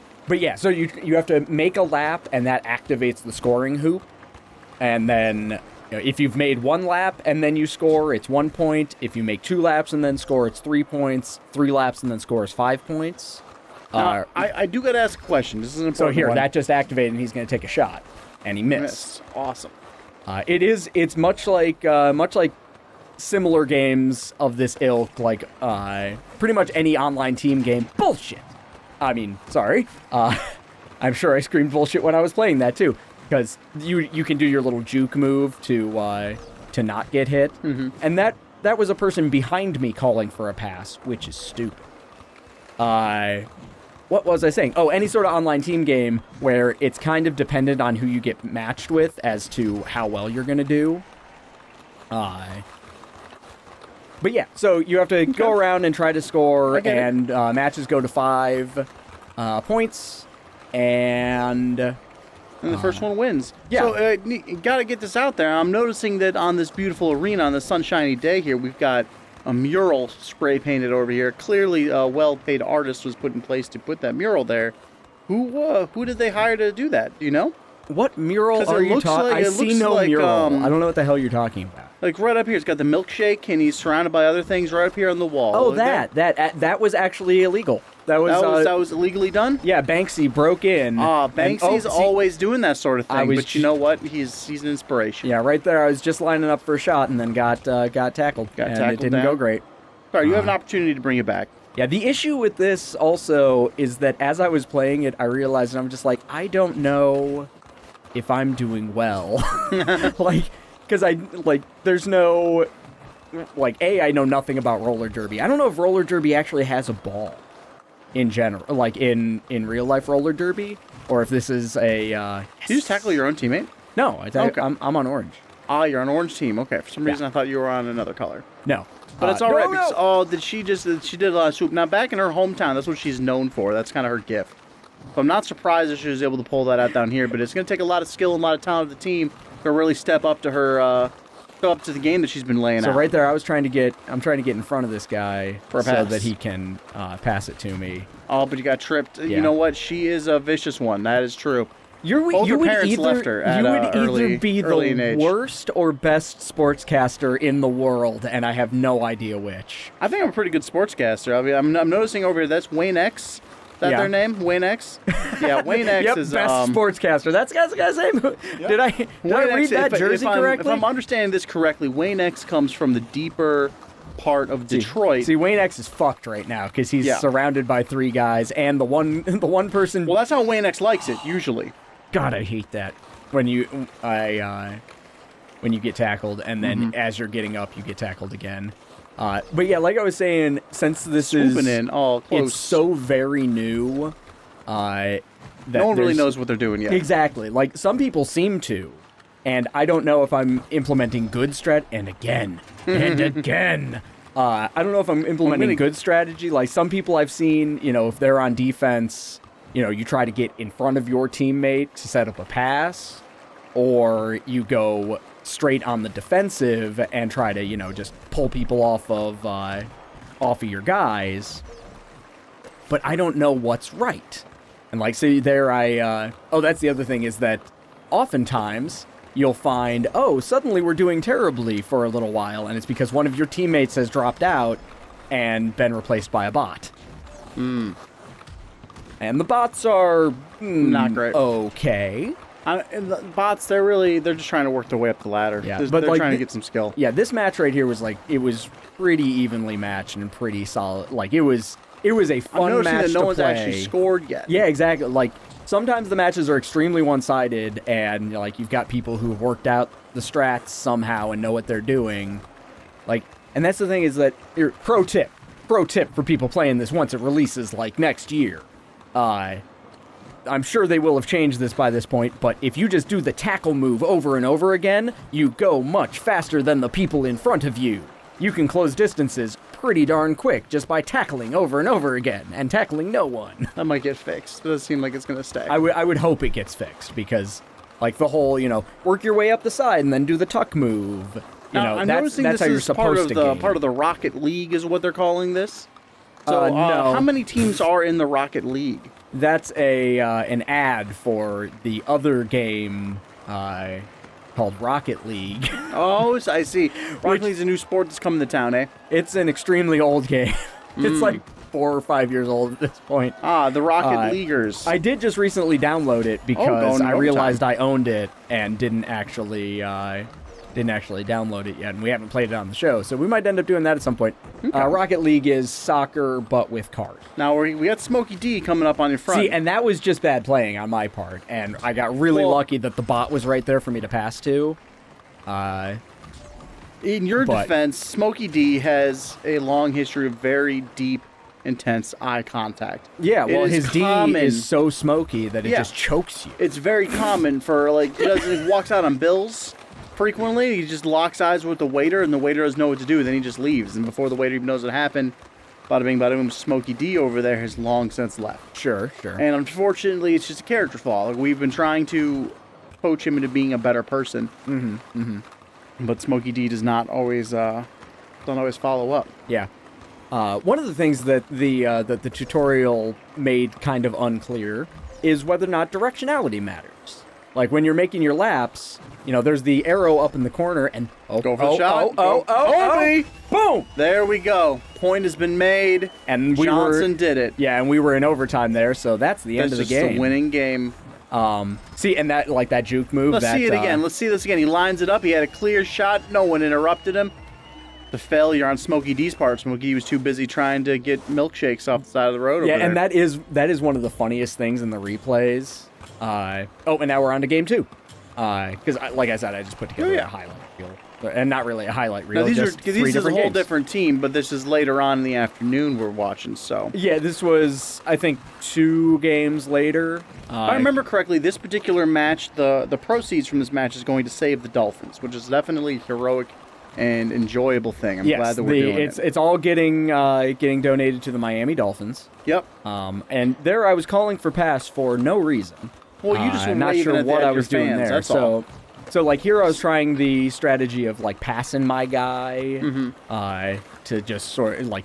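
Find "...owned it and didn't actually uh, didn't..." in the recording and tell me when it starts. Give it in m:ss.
5:17.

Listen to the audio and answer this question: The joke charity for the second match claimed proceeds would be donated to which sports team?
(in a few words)
Miami Dolphins.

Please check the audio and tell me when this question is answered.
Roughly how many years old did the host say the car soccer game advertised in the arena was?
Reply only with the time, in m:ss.
5:11.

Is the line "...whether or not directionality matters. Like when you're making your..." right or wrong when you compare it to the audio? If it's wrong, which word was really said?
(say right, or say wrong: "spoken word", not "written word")
right.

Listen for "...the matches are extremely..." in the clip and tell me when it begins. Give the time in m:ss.
4:16.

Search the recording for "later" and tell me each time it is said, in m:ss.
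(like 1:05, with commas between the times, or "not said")
6:54, 6:59.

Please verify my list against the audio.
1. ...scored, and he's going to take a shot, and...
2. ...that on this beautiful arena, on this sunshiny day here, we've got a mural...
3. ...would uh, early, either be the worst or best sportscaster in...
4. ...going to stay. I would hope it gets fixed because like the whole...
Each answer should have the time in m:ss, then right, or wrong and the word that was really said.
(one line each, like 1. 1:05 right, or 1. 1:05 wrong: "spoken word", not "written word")
1. 0:16 wrong: "activated", not "scored"
2. 1:06 right
3. 2:33 right
4. 4:45 right.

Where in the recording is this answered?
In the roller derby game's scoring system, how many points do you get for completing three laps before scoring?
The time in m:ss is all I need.
0:12.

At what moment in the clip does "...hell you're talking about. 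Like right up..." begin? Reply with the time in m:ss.
1:21.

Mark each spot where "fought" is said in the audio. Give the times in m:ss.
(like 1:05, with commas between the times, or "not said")
not said.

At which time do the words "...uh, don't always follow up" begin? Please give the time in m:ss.
6:07.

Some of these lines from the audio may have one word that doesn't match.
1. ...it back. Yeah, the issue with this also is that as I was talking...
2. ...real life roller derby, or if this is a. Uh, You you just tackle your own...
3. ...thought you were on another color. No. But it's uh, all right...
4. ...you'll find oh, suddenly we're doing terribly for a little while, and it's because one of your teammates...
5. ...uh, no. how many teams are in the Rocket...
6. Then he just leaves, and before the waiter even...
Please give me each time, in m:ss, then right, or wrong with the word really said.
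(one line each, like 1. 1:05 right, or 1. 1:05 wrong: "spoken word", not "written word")
1. 1:41 wrong: "playing", not "talking"
2. 1:59 wrong: "Did", not "You"
3. 2:07 right
4. 3:49 right
5. 4:56 right
6. 5:53 right.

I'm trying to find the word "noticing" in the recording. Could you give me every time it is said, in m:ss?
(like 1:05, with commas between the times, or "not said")
1:05, 2:41, 4:52.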